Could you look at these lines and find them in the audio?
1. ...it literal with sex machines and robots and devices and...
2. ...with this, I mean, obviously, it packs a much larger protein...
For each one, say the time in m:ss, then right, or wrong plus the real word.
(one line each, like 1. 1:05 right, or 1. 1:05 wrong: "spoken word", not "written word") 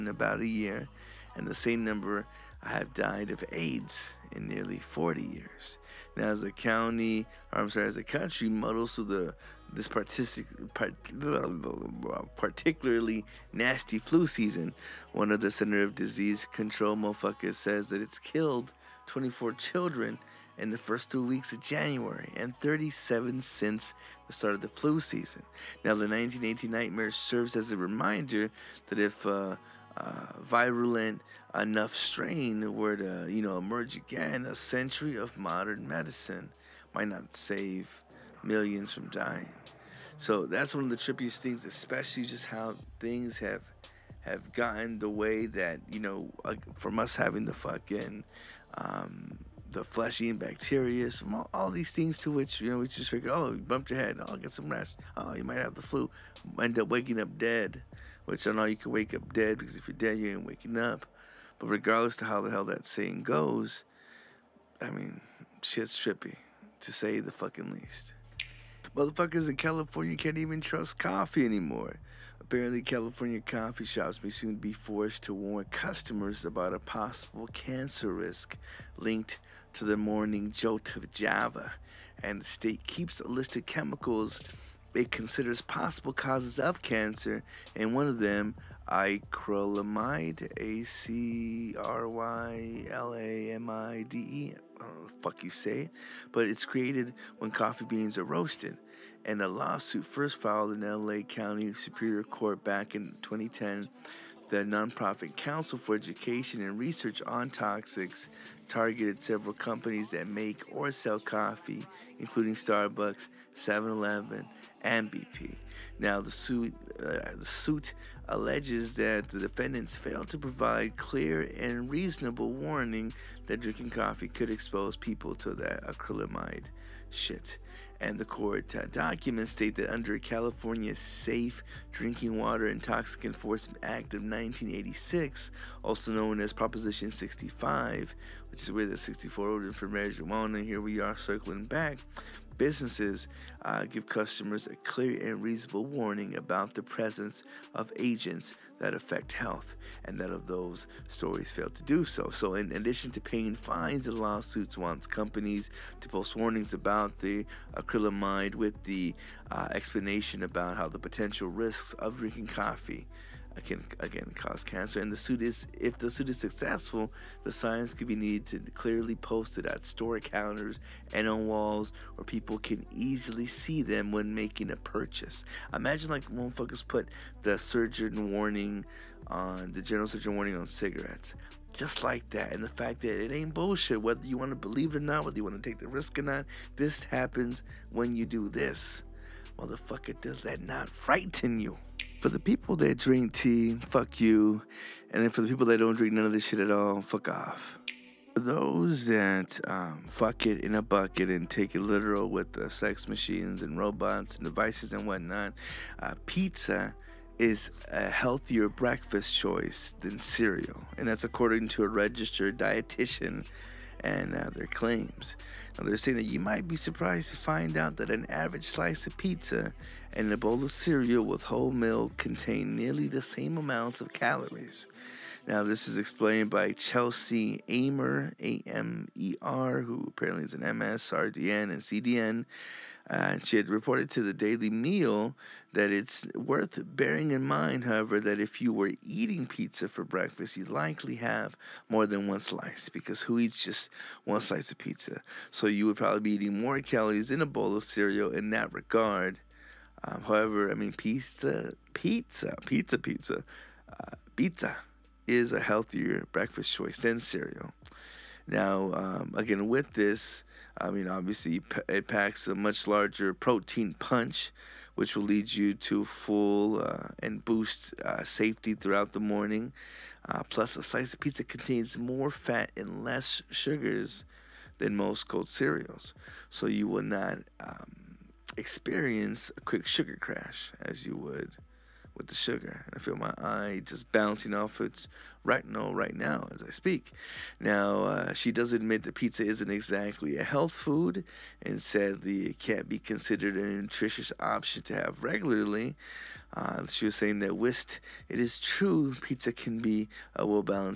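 1. 3:21 right
2. 4:19 right.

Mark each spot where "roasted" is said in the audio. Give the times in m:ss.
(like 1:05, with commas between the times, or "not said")
1:38.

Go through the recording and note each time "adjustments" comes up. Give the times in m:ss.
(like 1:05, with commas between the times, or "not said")
not said.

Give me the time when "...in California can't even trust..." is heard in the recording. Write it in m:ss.
1:09.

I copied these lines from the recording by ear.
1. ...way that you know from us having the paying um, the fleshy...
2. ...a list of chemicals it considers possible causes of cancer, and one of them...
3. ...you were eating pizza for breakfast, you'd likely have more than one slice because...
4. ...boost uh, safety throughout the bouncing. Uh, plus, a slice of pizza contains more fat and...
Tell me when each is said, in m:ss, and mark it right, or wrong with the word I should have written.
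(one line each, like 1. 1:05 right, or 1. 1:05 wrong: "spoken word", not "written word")
1. 0:45 wrong: "fucking", not "paying"
2. 1:23 right
3. 3:58 right
4. 4:27 wrong: "morning", not "bouncing".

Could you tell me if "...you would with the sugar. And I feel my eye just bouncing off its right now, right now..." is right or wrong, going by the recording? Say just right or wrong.
right.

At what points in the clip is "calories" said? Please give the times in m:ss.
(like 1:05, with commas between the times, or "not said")
3:44, 4:06.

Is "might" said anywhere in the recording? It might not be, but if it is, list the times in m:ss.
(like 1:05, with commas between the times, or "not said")
0:36, 0:55, 3:36.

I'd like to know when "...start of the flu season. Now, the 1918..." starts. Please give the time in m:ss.
0:24.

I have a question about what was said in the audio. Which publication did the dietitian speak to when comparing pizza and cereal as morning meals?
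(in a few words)
The Daily Meal.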